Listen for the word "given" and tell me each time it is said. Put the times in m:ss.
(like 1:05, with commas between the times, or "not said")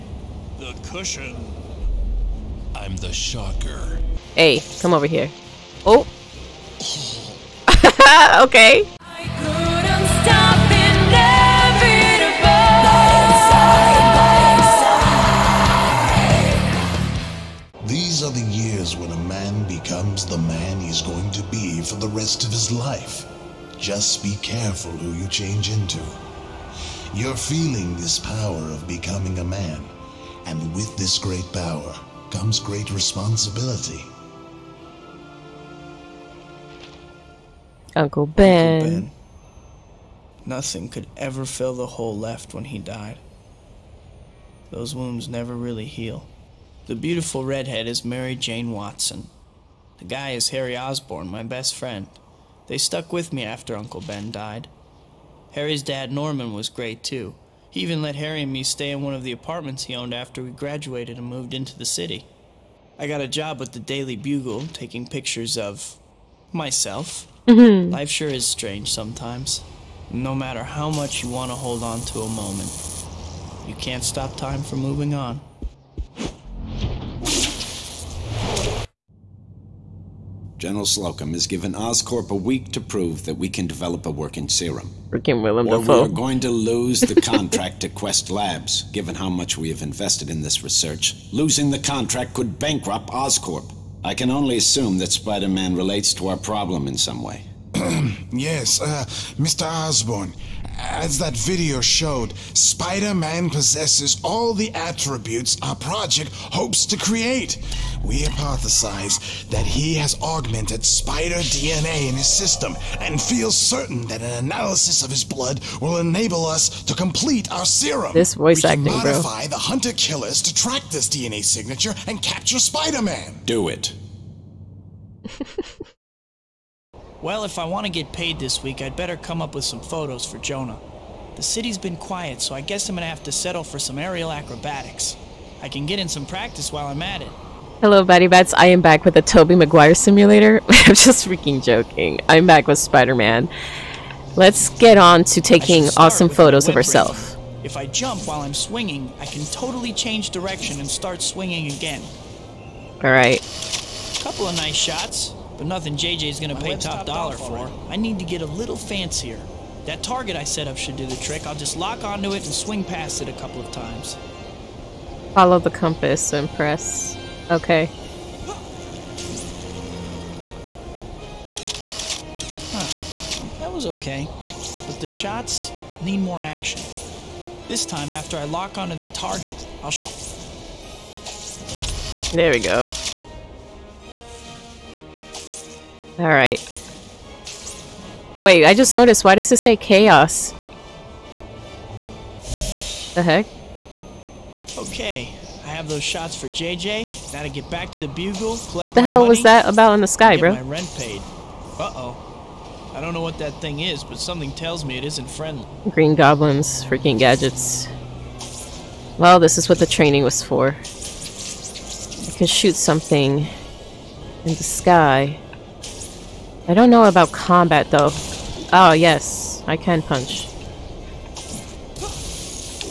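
1:21, 1:28.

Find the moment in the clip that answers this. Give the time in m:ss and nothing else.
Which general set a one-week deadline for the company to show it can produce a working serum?
1:20.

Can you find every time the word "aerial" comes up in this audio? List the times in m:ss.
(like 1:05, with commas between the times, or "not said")
2:13.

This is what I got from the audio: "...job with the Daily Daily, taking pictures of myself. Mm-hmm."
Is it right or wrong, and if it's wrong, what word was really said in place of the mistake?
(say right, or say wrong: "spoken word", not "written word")
wrong: "Bugle", not "Daily".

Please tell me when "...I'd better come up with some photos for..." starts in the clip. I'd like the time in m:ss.
2:08.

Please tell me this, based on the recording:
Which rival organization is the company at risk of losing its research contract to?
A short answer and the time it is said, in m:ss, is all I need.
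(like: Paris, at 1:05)
Quest Labs, at 1:27.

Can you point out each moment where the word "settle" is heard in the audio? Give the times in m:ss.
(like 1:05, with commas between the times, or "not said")
2:13.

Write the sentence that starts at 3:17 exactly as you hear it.
Now to get back to the bugle, What the hell money, was that about in the sky, bro?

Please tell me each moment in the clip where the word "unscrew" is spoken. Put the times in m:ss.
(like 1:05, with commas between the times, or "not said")
not said.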